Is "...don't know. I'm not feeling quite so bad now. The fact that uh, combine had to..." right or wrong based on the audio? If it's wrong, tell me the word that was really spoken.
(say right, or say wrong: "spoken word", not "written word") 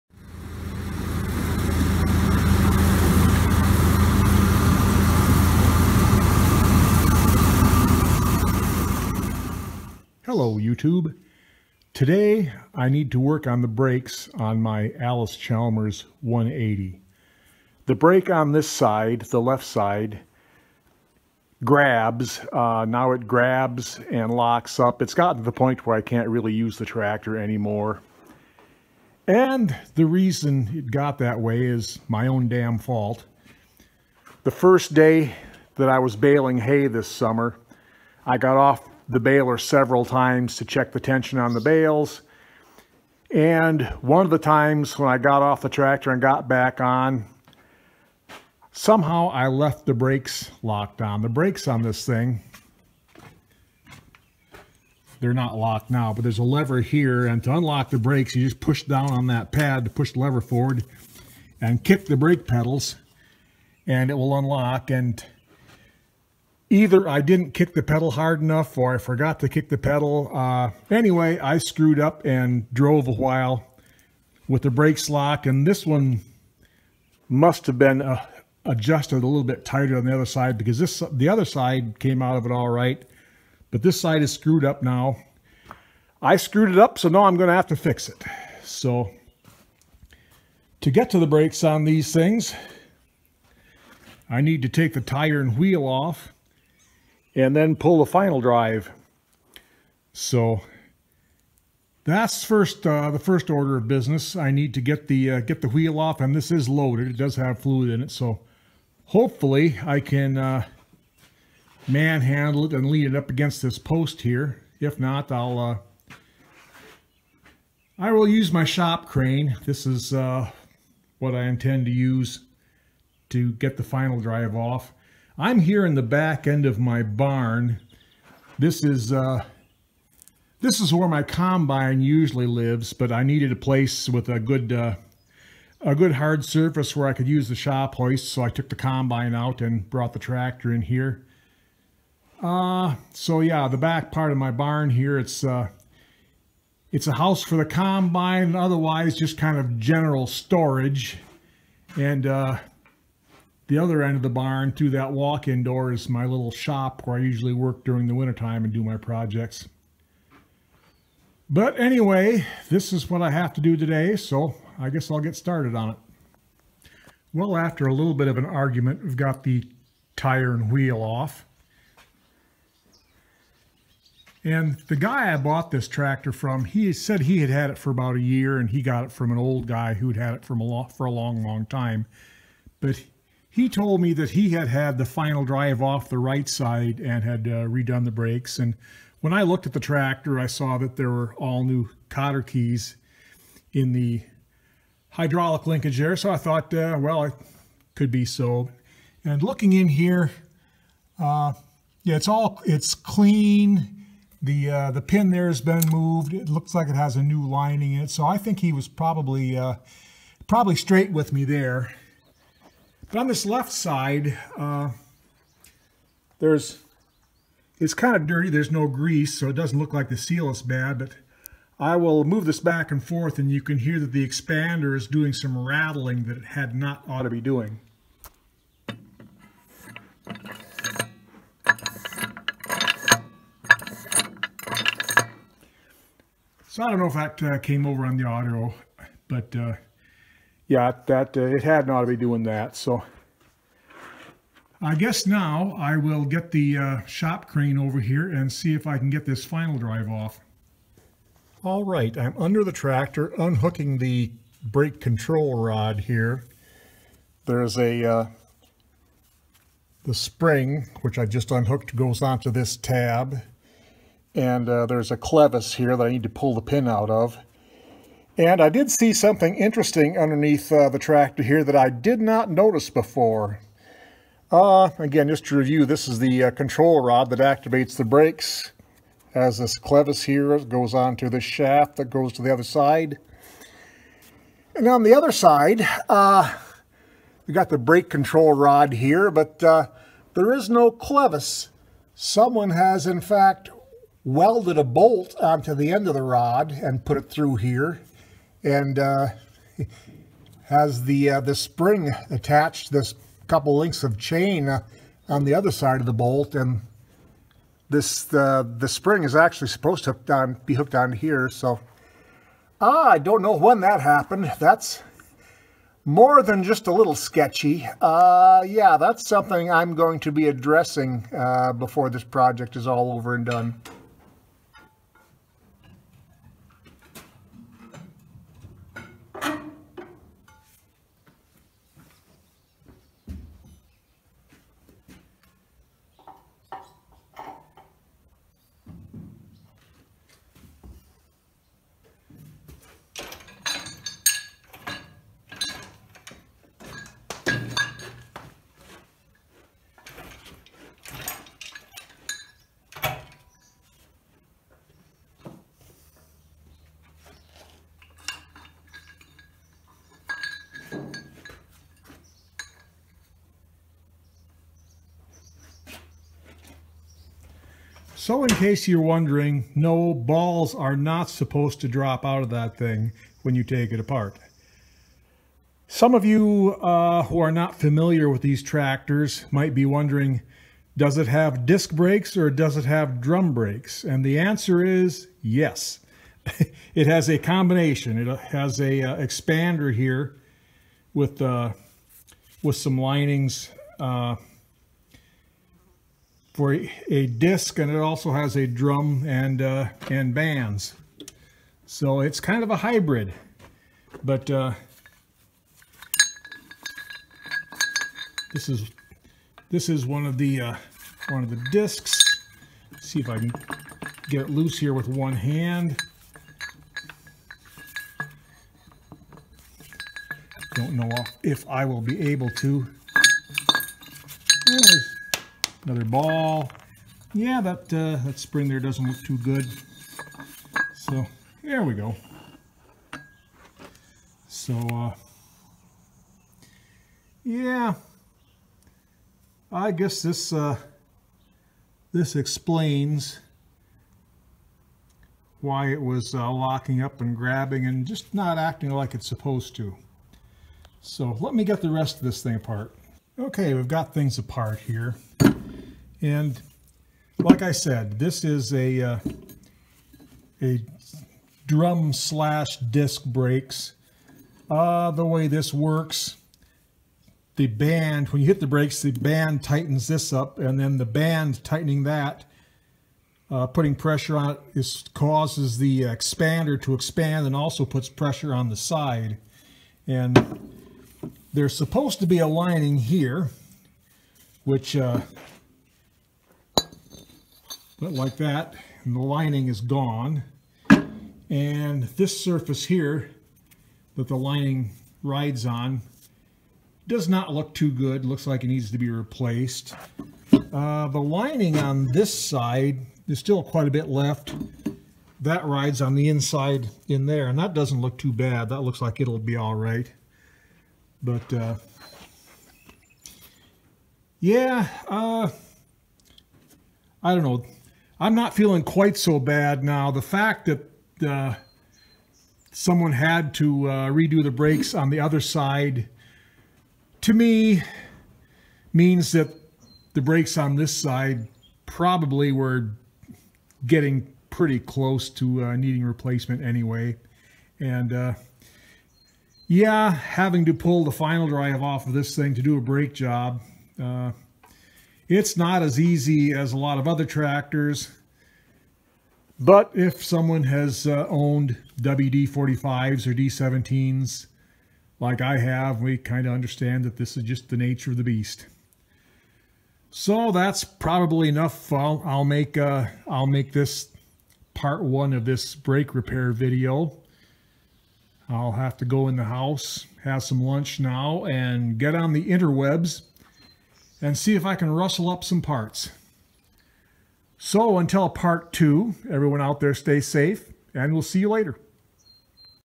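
wrong: "someone", not "combine".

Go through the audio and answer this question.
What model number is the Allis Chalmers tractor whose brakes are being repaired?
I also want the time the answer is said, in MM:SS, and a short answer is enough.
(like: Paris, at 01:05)
180, at 00:14.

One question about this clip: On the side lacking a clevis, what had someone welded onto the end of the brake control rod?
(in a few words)
A bolt.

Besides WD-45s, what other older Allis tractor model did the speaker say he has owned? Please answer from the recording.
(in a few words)
D-17.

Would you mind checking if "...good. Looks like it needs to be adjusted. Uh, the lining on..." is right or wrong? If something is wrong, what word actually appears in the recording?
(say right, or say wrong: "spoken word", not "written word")
wrong: "replaced", not "adjusted".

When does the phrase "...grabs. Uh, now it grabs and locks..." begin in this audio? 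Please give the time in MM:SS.
00:21.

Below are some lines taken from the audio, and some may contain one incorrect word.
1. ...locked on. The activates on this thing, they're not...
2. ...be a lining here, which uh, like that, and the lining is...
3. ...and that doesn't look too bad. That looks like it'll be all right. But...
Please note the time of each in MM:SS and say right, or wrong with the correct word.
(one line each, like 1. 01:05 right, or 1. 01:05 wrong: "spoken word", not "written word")
1. 00:50 wrong: "brakes", not "activates"
2. 08:02 right
3. 08:27 right.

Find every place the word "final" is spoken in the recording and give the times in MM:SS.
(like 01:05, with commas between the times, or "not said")
01:38, 02:03, 03:05, 04:09, 09:01.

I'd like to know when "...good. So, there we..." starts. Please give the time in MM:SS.
07:09.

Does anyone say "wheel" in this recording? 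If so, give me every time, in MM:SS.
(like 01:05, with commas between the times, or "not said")
01:35, 01:45, 02:50.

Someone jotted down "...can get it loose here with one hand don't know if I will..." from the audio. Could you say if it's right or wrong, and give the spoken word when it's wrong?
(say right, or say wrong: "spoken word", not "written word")
right.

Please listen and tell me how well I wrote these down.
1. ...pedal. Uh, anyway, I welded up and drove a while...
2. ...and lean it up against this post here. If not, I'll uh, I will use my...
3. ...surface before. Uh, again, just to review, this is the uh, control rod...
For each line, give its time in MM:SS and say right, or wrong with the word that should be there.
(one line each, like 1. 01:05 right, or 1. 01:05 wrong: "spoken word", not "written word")
1. 01:09 wrong: "screwed", not "welded"
2. 01:52 right
3. 04:32 wrong: "notice", not "surface".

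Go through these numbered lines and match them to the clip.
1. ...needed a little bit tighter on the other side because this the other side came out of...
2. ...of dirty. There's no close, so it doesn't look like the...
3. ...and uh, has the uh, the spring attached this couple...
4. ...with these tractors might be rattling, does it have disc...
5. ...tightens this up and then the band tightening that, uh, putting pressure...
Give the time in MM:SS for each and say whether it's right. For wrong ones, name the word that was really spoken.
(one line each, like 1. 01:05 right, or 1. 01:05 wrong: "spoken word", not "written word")
1. 01:18 wrong: "adjusted", not "needed"
2. 03:38 wrong: "grease", not "close"
3. 04:58 right
4. 06:18 wrong: "wondering", not "rattling"
5. 07:49 right.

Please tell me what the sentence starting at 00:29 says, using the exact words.
And the reason it got that way is my own damn fault.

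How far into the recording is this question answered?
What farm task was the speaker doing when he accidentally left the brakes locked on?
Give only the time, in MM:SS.
00:36.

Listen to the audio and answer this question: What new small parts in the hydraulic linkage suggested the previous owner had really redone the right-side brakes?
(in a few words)
Cotter keys.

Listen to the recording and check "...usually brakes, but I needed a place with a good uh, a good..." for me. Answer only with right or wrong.
wrong.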